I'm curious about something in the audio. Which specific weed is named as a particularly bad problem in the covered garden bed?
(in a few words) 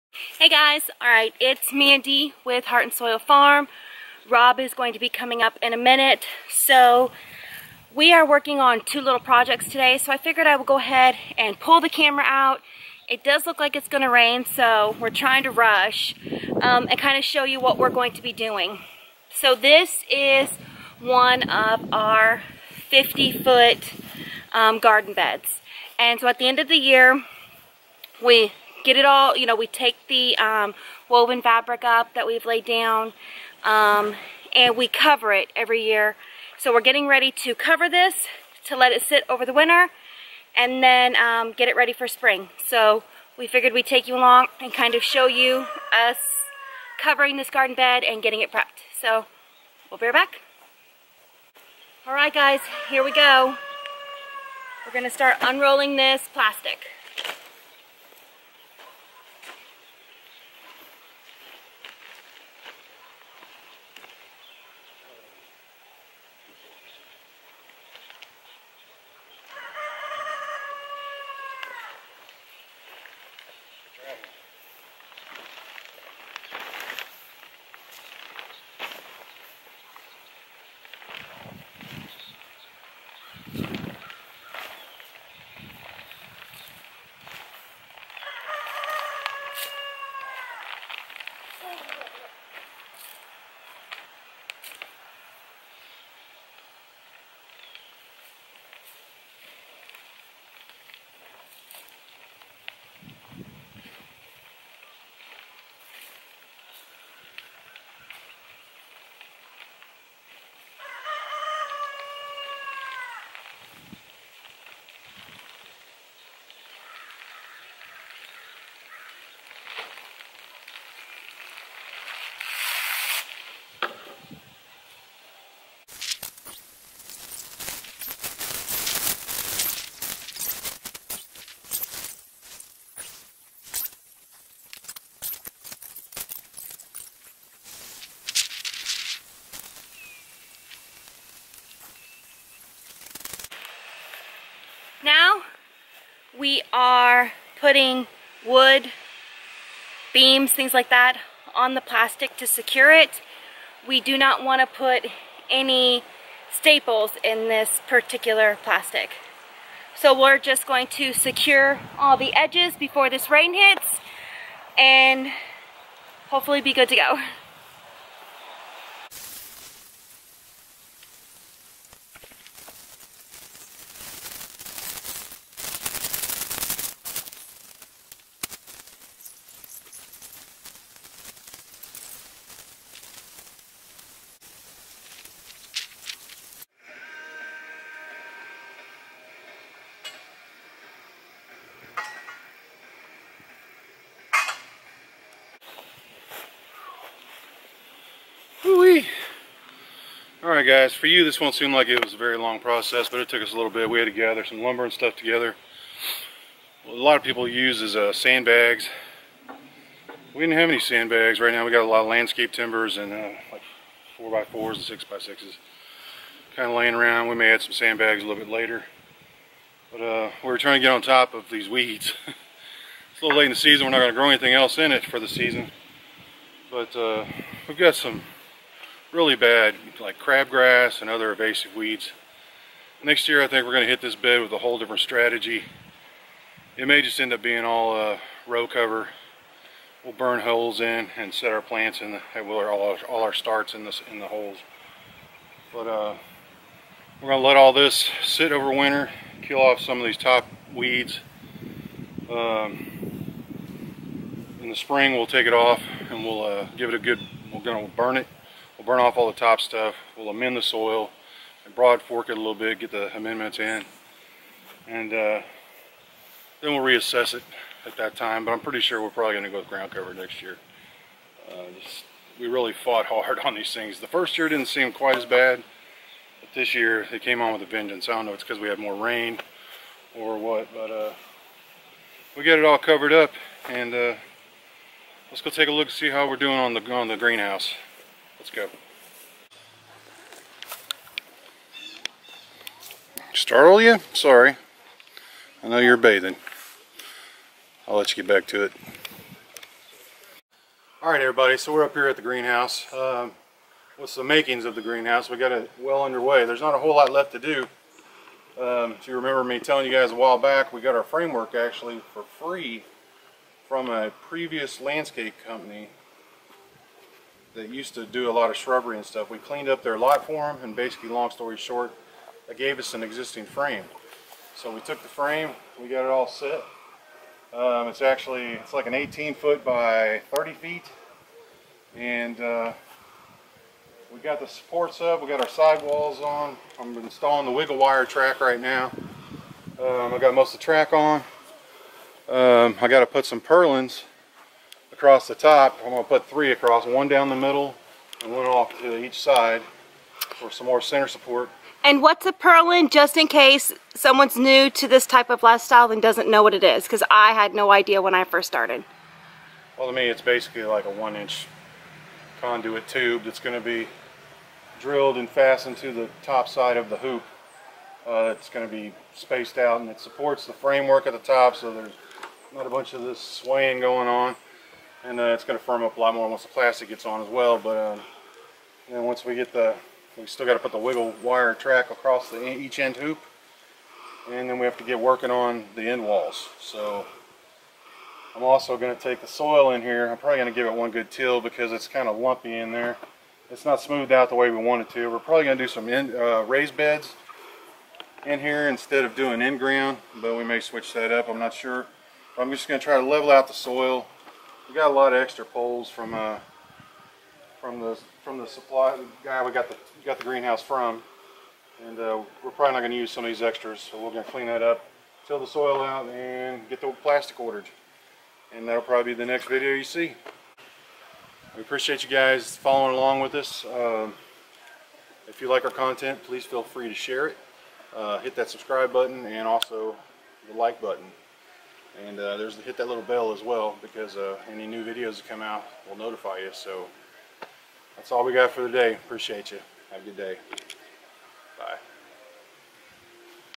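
Crabgrass.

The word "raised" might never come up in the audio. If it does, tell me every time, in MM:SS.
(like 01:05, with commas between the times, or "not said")
06:36.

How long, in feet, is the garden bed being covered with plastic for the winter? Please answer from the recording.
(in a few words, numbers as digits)
50 feet.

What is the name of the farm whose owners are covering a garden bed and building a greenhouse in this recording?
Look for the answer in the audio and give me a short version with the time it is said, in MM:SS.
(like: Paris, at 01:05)
Heart and Soil Farm, at 00:02.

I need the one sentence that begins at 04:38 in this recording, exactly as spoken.
I don't know it's because we had more rain or what.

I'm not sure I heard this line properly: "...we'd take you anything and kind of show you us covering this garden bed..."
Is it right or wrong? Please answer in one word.
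wrong.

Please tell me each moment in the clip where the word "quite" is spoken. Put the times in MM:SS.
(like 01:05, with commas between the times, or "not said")
04:34.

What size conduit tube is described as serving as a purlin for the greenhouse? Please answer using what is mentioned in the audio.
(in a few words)
One-inch.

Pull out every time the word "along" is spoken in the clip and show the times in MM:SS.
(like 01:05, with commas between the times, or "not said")
00:44, 07:02.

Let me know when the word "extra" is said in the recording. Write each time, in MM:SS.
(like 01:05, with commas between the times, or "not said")
06:45, 06:53.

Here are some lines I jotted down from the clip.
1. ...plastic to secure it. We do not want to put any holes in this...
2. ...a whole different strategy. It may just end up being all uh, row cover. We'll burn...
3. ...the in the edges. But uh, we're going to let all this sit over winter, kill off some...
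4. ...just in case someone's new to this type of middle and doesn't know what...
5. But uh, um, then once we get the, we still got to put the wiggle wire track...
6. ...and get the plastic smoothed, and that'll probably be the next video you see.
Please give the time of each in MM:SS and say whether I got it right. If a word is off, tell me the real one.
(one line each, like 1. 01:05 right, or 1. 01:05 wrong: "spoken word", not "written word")
1. 02:31 wrong: "staples", not "holes"
2. 03:54 right
3. 04:03 wrong: "holes", not "edges"
4. 05:52 wrong: "lifestyle", not "middle"
5. 06:17 right
6. 06:56 wrong: "ordered", not "smoothed".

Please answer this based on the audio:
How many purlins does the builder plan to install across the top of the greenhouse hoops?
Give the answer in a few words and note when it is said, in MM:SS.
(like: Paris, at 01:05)
3, at 05:46.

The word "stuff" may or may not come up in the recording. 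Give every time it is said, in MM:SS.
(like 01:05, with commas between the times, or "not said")
03:24, 04:19, 05:19.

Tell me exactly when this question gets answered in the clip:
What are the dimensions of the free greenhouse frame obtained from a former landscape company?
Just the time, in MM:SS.
05:28.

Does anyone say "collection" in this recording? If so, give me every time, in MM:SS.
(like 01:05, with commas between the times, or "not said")
not said.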